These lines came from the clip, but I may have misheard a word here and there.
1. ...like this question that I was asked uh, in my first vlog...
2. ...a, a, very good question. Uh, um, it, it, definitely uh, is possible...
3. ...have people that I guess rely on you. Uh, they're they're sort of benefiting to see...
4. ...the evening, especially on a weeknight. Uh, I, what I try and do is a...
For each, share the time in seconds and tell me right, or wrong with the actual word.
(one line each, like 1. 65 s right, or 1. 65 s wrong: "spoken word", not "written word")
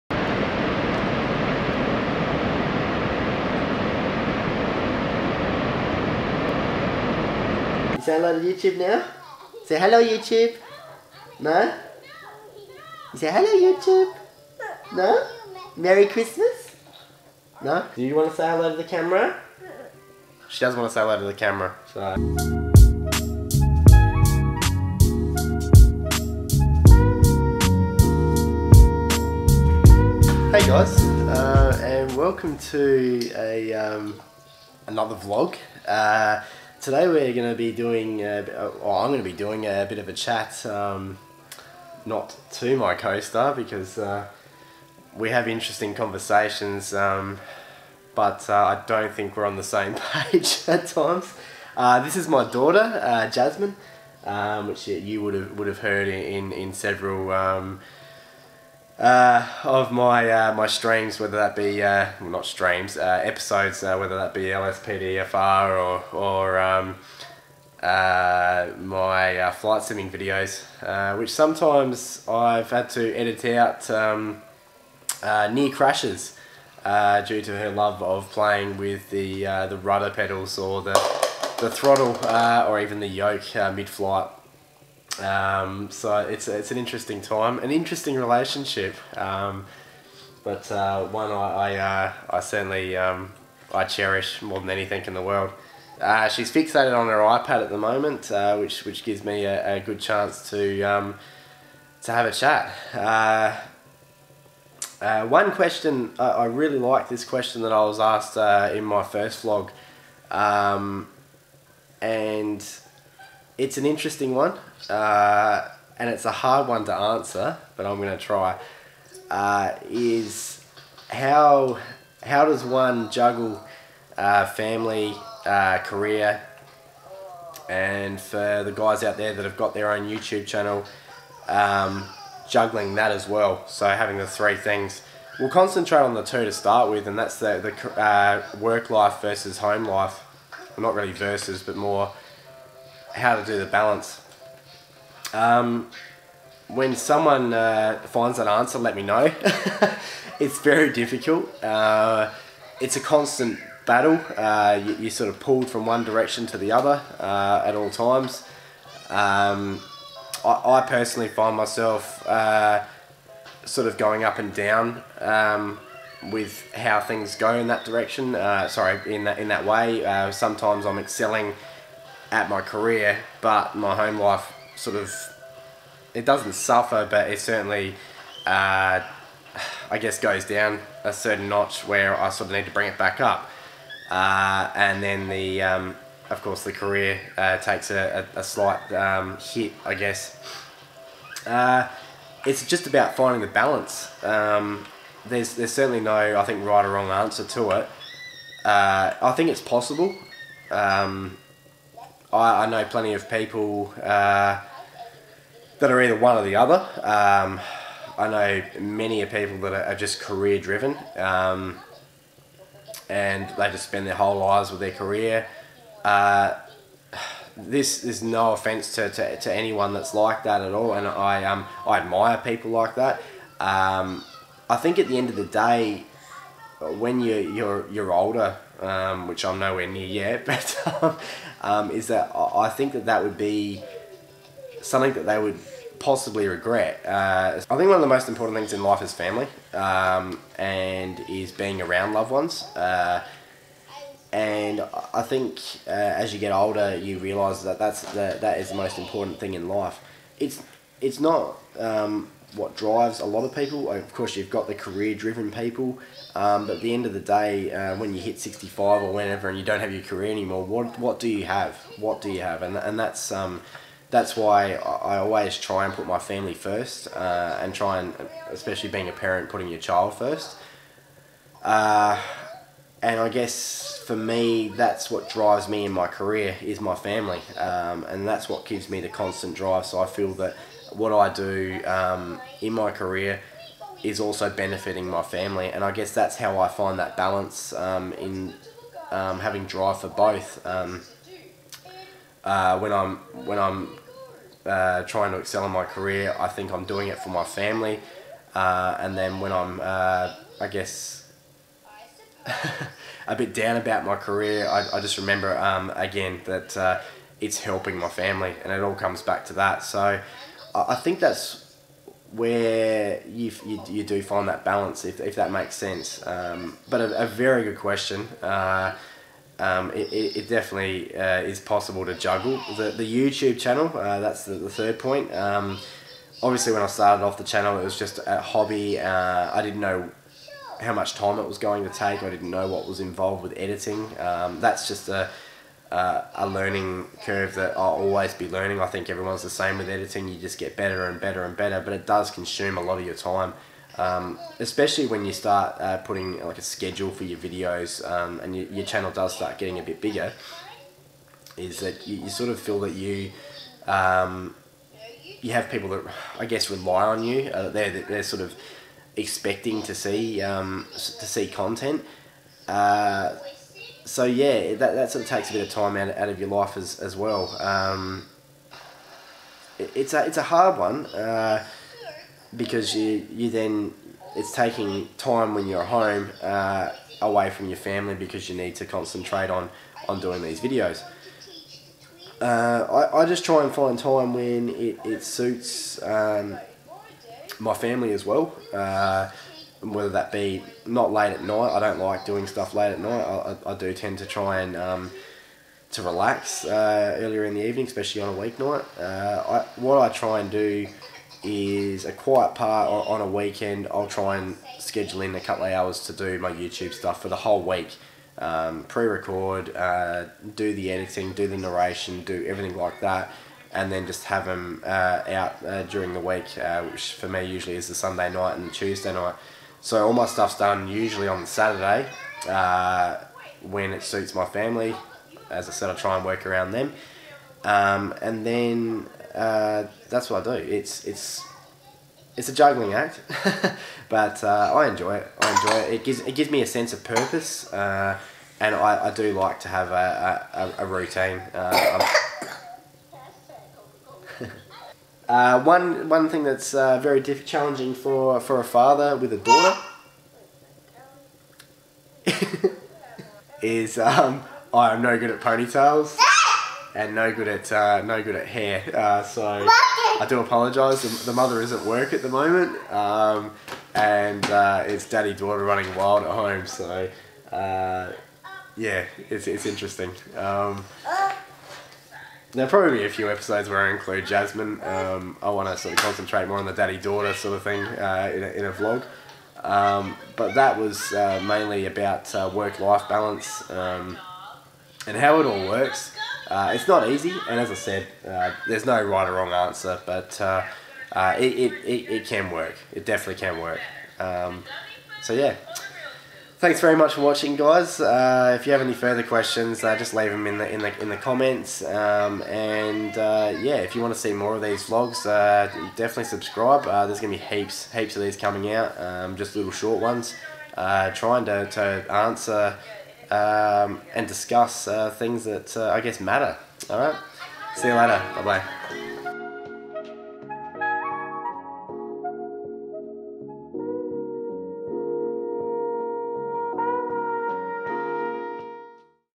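1. 106 s right
2. 317 s right
3. 355 s wrong: "expecting", not "benefiting"
4. 397 s right.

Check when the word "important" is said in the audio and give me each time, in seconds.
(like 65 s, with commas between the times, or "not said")
238 s, 248 s.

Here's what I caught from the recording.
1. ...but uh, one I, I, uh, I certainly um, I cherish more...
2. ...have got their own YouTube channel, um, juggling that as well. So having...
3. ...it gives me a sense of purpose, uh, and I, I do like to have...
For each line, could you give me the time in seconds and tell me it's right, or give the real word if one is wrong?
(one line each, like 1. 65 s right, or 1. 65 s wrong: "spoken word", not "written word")
1. 90 s right
2. 129 s right
3. 436 s right.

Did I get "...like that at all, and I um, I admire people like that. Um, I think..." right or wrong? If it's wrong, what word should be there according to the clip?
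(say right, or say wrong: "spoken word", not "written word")
right.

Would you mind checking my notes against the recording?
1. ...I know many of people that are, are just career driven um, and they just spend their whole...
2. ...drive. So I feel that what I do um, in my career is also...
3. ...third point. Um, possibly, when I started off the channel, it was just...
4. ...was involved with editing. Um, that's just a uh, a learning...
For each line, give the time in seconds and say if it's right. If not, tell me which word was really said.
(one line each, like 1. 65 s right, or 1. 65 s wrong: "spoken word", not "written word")
1. 208 s right
2. 279 s right
3. 324 s wrong: "obviously", not "possibly"
4. 332 s right.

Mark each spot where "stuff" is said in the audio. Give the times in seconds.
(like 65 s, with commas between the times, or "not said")
392 s, 406 s, 420 s.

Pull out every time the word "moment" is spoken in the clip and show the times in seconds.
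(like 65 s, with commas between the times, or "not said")
97 s, 462 s.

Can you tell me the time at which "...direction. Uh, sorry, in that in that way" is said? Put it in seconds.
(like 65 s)
167 s.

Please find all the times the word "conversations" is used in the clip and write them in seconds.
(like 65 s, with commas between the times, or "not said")
45 s.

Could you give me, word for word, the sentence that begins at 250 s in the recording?
It's it's not um, what drives a lot of people.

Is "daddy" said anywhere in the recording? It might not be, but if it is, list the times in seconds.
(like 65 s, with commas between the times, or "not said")
465 s, 476 s.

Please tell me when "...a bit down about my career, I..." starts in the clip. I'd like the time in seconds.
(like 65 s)
303 s.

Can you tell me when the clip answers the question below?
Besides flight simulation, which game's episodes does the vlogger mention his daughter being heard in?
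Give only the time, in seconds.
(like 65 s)
64 s.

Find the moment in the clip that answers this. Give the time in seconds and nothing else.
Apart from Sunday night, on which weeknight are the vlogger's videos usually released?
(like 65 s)
418 s.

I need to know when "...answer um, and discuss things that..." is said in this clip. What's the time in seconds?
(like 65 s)
512 s.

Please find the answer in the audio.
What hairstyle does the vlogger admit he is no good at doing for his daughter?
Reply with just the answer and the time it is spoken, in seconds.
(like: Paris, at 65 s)
Ponytails, at 455 s.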